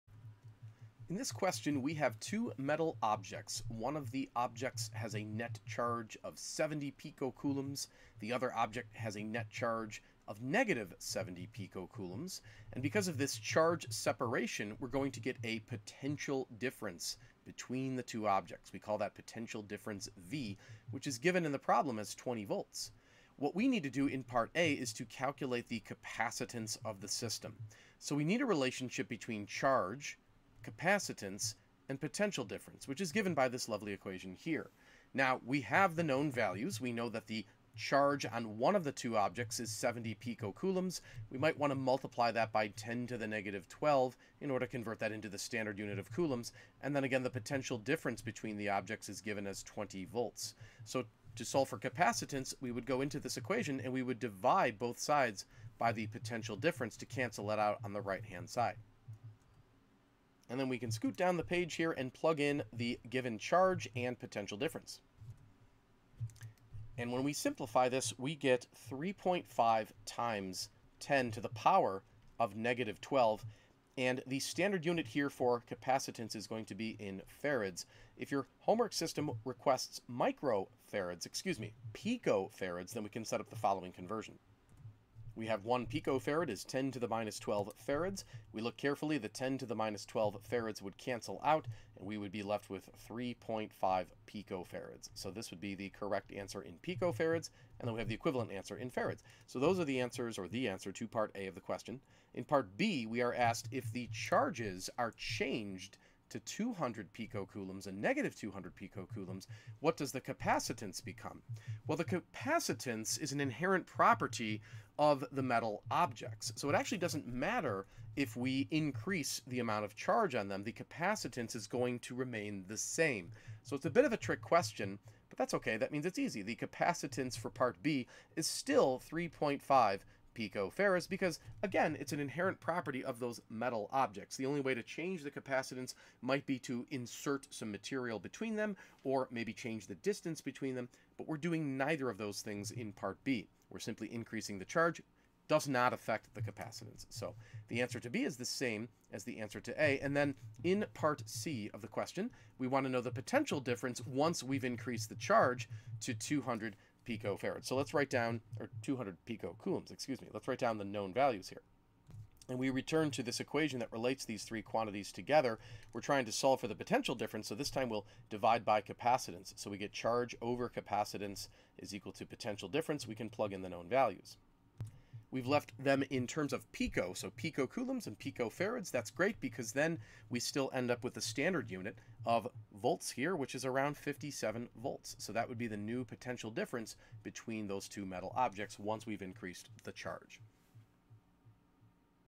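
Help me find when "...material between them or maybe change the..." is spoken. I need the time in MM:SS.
02:17.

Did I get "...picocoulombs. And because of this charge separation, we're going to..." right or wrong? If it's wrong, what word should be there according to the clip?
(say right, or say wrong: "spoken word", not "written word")
right.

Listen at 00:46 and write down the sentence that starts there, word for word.
And then again, the potential difference between the objects is given as 20 volts.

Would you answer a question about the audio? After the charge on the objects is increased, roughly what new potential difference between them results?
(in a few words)
57 volts.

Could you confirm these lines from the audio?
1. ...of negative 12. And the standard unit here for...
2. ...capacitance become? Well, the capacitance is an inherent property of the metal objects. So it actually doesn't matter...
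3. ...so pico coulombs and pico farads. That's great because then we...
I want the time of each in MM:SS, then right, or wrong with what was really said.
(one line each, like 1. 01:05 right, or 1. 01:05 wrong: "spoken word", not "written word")
1. 01:12 right
2. 01:50 right
3. 02:57 right.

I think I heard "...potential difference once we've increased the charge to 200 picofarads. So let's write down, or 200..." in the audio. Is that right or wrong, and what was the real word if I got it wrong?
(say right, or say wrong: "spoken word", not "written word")
right.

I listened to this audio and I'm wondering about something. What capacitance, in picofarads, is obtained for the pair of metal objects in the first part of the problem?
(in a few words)
3.5 picofarads.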